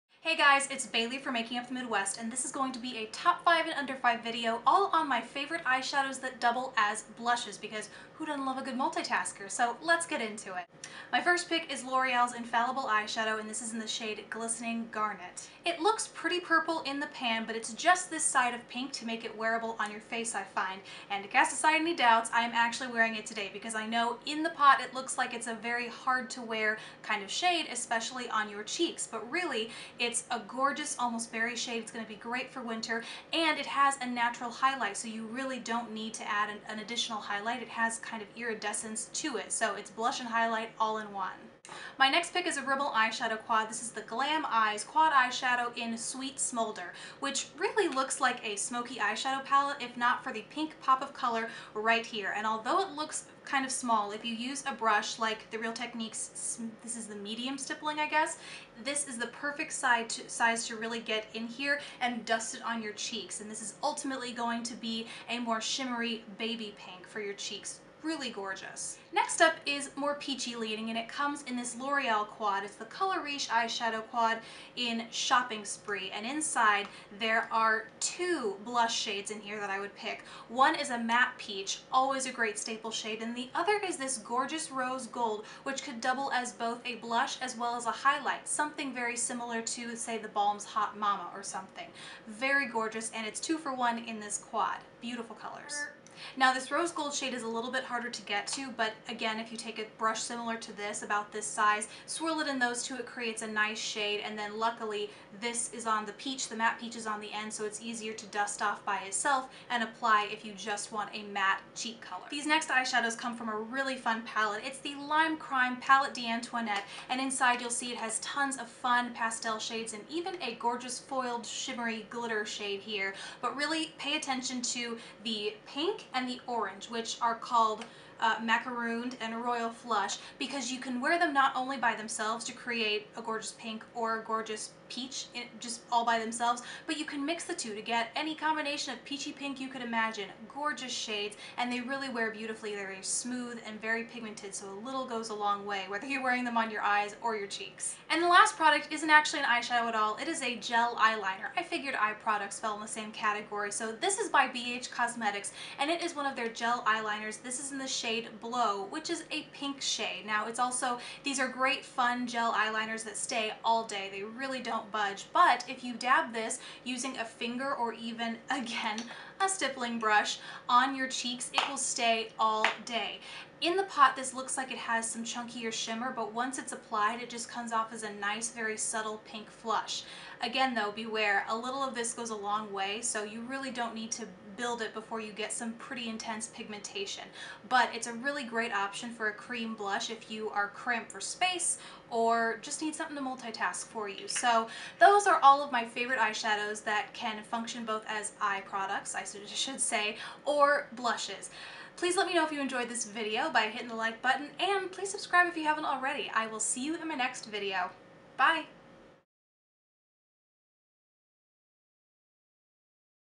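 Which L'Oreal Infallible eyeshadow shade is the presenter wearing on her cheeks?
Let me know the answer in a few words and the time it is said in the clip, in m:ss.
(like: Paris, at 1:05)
Glistening Garnet, at 0:14.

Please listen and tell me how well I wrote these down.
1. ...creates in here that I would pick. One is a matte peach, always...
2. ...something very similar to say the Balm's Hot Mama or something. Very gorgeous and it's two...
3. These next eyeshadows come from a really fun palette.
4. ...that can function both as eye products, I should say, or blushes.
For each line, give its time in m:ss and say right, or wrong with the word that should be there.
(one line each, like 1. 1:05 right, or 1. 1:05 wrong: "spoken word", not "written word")
1. 1:18 wrong: "shades", not "creates"
2. 1:28 right
3. 1:52 right
4. 3:16 right.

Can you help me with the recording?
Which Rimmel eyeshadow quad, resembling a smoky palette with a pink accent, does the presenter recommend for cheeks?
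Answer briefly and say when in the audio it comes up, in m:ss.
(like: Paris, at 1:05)
Sweet Smoulder, at 0:45.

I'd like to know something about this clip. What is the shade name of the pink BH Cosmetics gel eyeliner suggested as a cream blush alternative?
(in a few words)
Blow.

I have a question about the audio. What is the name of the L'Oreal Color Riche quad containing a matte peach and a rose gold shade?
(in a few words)
Shopping Spree.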